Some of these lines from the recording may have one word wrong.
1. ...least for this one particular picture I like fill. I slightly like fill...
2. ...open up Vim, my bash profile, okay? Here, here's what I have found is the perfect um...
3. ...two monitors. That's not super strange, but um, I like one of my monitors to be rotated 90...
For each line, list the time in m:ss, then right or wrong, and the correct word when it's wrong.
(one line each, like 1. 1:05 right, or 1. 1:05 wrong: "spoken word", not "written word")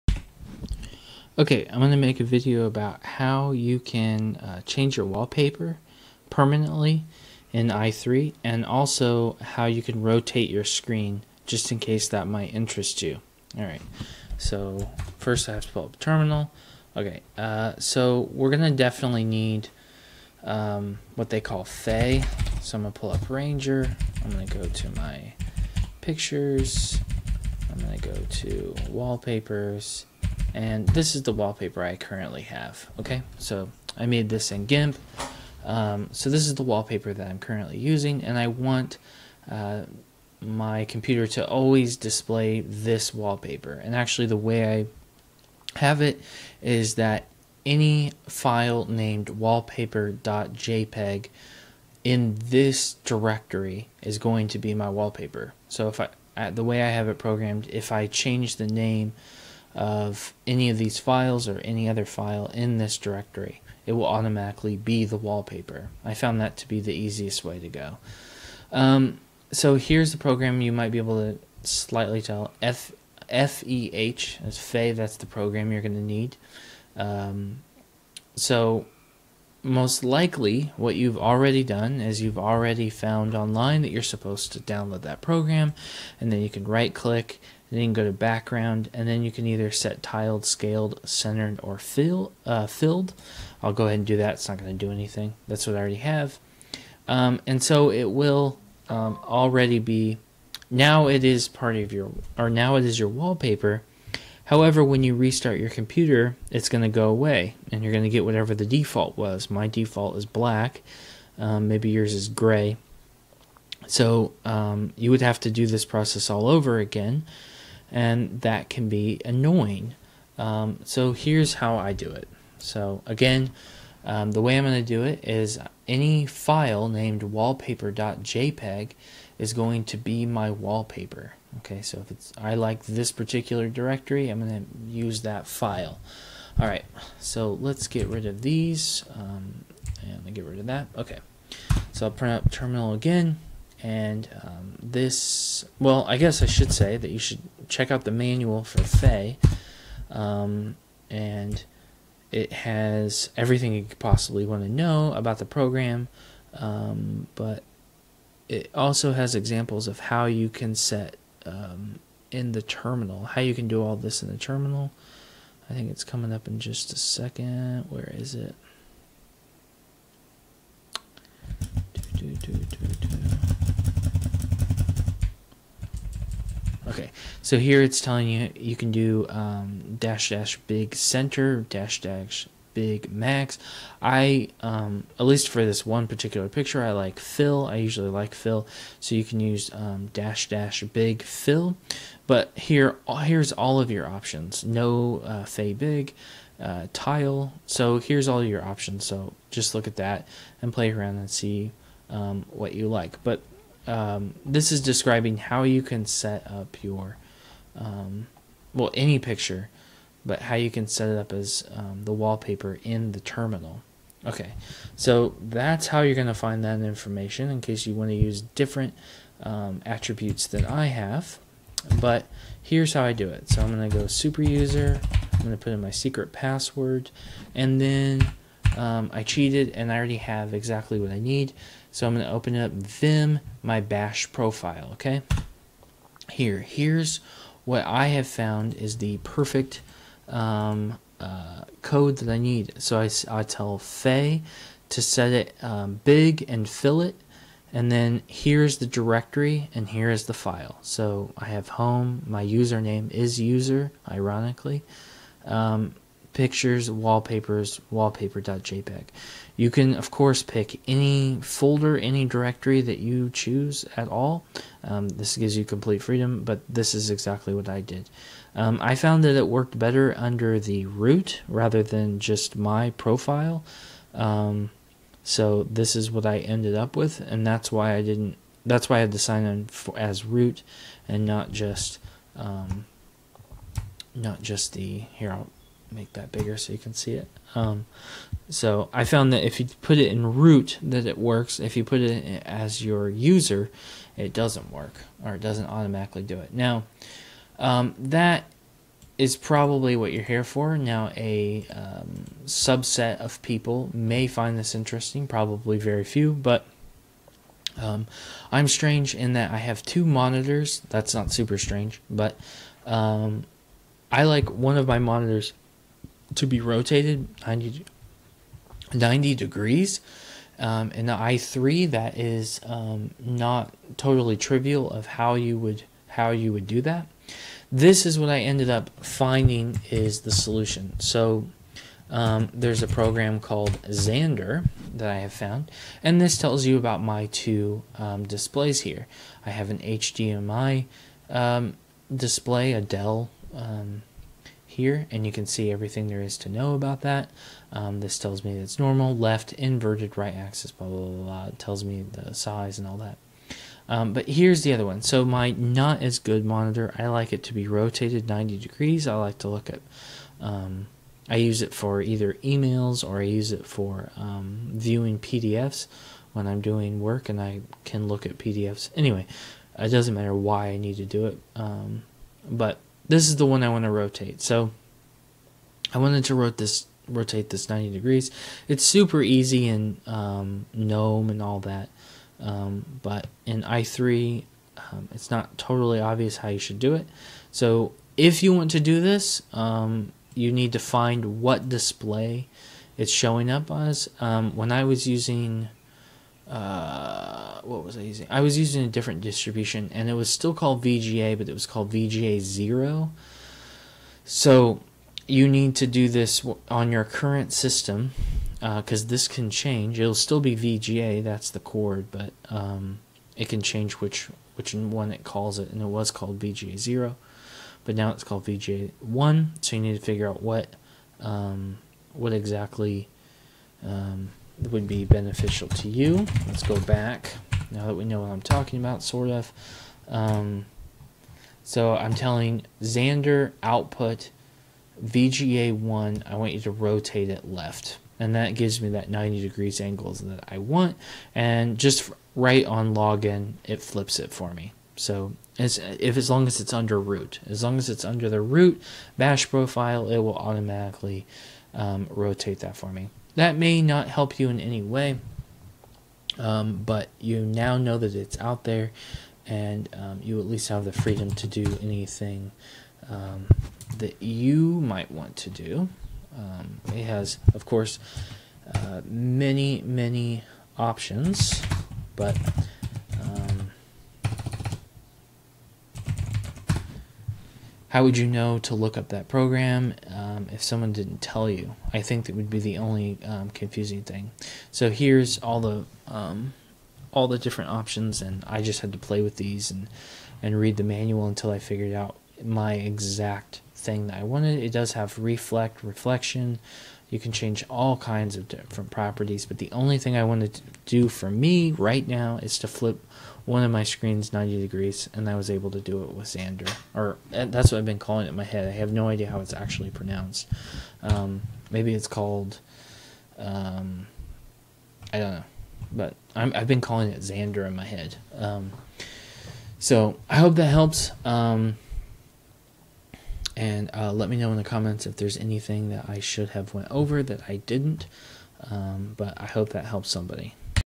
1. 3:05 wrong: "usually", not "slightly"
2. 3:52 right
3. 5:09 right.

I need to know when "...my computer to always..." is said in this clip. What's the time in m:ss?
0:40.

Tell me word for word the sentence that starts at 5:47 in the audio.
Um, this tells me it's normal, left, inverted, right axis, blah, blah, blah, blah.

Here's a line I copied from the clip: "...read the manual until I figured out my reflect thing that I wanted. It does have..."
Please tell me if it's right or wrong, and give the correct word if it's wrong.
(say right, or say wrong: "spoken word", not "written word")
wrong: "exact", not "reflect".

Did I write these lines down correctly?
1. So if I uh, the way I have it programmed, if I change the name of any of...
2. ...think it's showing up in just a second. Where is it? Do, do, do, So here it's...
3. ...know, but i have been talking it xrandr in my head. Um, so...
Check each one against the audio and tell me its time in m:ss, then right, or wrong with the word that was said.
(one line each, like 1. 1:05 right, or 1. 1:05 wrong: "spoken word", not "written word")
1. 0:55 right
2. 2:45 wrong: "coming", not "showing"
3. 8:35 wrong: "calling", not "talking".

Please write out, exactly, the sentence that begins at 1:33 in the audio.
I'll go ahead and do that.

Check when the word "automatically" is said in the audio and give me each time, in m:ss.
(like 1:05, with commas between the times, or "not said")
1:04, 4:55, 7:30.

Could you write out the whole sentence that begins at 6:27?
So if you want to do this, um, you need to find what display it's showing up as.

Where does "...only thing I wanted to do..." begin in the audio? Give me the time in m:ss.
8:19.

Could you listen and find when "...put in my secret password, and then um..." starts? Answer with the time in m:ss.
3:45.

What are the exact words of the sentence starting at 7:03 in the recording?
Um, would be beneficial to you.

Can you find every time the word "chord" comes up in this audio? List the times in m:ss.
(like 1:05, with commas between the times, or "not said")
6:51.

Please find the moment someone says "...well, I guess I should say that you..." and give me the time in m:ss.
2:25.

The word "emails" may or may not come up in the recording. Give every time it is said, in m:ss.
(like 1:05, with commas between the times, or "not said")
6:02.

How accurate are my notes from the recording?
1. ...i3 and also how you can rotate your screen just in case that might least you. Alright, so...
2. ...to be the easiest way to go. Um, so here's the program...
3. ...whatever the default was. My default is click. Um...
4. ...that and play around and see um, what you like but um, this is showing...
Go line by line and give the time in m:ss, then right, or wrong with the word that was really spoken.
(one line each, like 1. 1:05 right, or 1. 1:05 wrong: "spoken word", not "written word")
1. 0:07 wrong: "interest", not "least"
2. 1:06 right
3. 1:48 wrong: "black", not "click"
4. 3:19 wrong: "describing", not "showing".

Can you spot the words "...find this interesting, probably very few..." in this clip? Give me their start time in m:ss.
5:04.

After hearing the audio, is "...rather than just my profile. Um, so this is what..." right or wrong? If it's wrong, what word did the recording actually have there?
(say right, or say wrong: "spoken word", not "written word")
right.